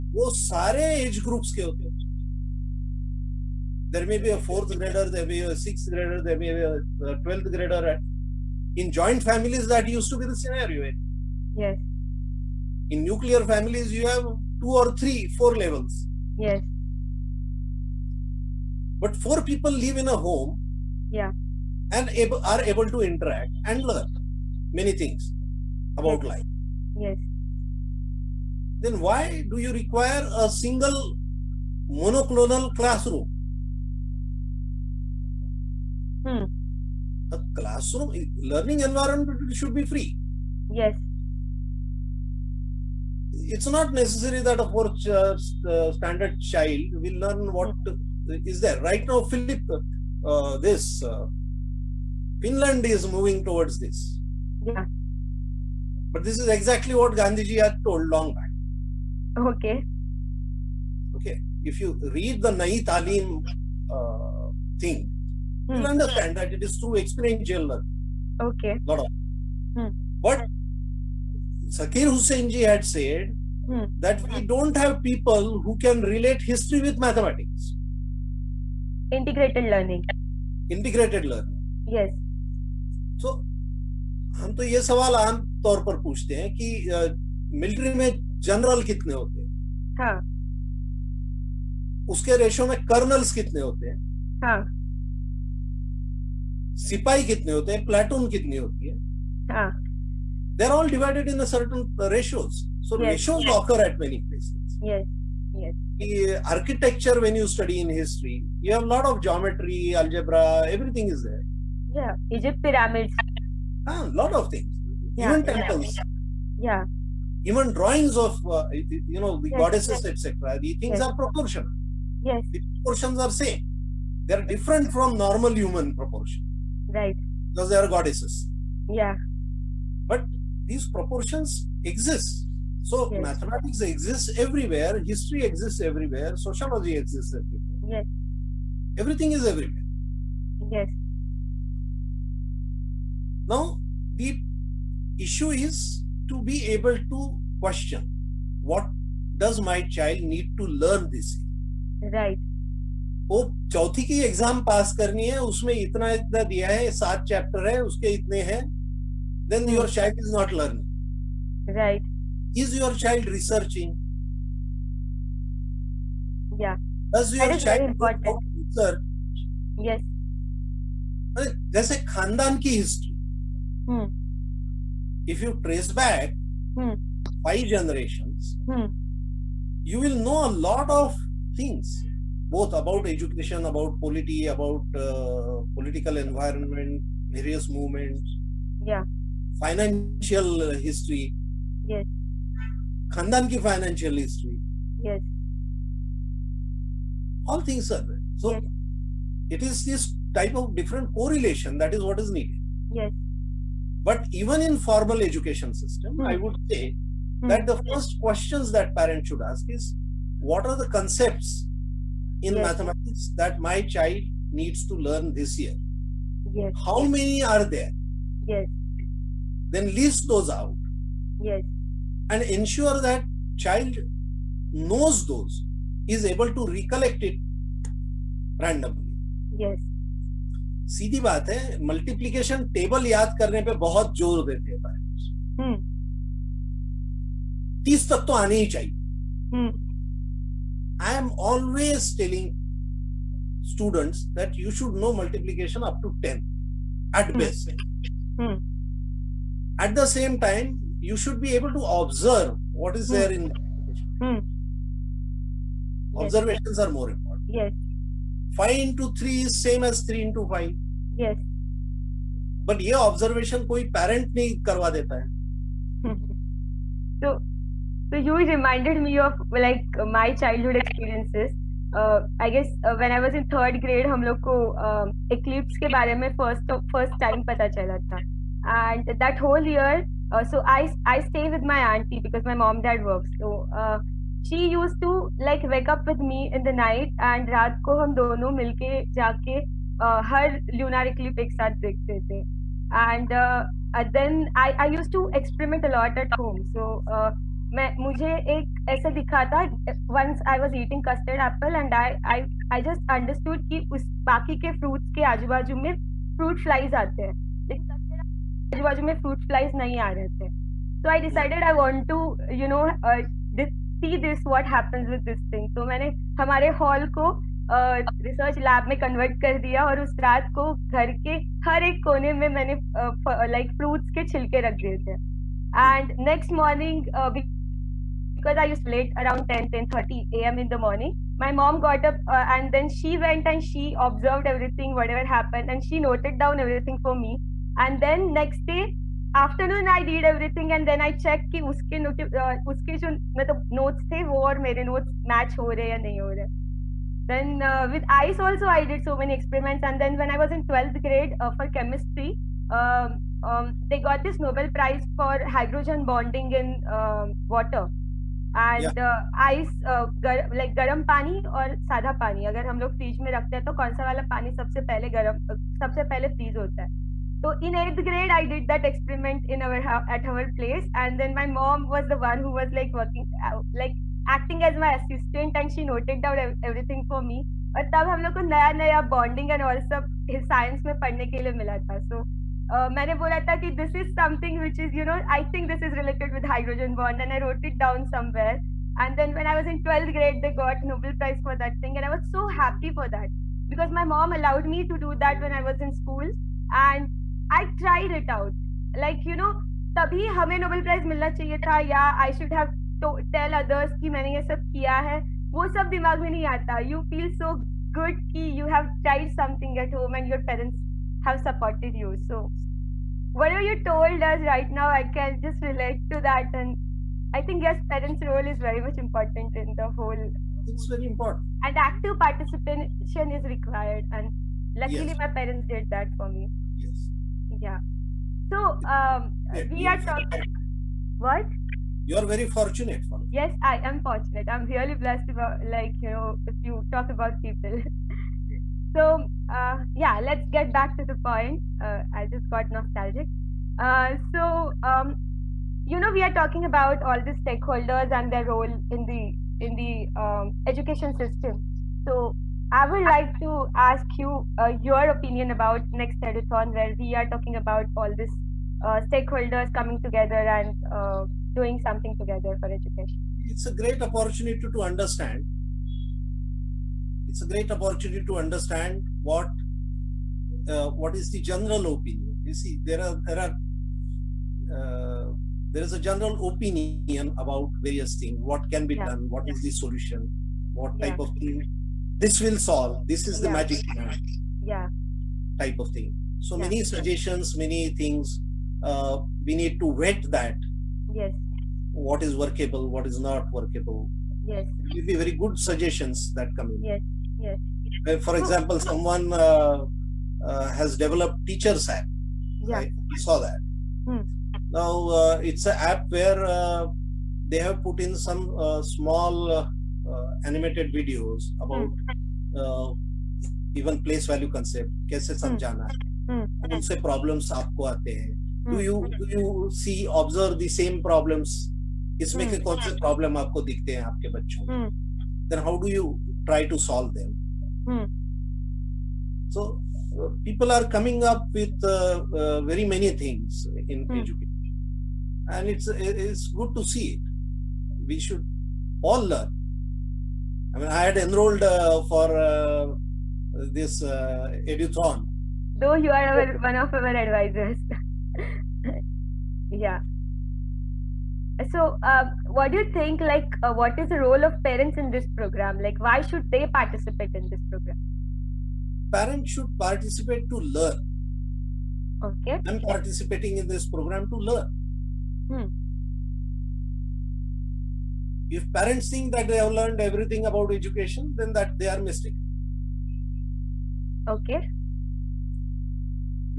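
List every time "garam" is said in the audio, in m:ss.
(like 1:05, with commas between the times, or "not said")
6:00, 6:05.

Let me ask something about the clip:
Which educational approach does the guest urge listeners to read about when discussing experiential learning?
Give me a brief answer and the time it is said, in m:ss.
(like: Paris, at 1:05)
Nai Talim, at 1:02.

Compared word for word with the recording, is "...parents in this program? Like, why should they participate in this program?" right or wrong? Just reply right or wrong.
right.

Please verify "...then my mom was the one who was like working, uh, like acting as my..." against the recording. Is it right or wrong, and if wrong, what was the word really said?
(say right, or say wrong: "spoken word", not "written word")
right.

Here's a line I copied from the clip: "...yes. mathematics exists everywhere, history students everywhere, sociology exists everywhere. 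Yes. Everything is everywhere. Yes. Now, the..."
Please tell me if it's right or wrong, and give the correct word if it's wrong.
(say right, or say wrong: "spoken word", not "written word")
wrong: "exists", not "students".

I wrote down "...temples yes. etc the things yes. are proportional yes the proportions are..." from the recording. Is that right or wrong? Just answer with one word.
wrong.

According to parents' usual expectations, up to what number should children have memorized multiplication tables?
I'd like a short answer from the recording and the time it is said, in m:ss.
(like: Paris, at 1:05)
30, at 3:57.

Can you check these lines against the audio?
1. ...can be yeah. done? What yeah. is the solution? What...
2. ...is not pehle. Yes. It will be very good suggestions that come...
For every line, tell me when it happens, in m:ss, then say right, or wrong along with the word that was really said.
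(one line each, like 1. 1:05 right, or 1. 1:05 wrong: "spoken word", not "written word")
1. 7:58 right
2. 8:13 wrong: "workable", not "pehle".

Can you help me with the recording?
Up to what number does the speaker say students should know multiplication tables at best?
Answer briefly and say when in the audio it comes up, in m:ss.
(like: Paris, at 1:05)
10, at 4:05.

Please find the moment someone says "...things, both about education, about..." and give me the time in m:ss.
3:01.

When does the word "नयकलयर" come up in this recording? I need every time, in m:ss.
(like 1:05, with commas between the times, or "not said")
0:13.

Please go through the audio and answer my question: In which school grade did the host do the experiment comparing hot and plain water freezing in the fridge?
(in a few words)
Eighth grade.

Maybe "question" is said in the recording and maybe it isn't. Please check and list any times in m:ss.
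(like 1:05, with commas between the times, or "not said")
2:27, 3:28.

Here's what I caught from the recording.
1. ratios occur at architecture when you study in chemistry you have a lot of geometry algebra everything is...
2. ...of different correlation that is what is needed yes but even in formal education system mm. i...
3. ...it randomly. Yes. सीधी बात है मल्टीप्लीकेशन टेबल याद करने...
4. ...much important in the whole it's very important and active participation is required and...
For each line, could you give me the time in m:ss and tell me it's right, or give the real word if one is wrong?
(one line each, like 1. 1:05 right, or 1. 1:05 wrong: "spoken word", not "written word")
1. 1:43 wrong: "history", not "chemistry"
2. 3:20 right
3. 3:47 right
4. 6:58 right.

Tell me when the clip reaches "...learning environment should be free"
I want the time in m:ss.
0:38.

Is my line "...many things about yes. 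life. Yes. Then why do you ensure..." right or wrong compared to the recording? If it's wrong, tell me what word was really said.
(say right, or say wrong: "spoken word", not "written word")
wrong: "require", not "ensure".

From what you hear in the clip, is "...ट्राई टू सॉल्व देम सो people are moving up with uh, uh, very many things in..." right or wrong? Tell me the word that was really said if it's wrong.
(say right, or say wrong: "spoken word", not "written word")
wrong: "coming", not "moving".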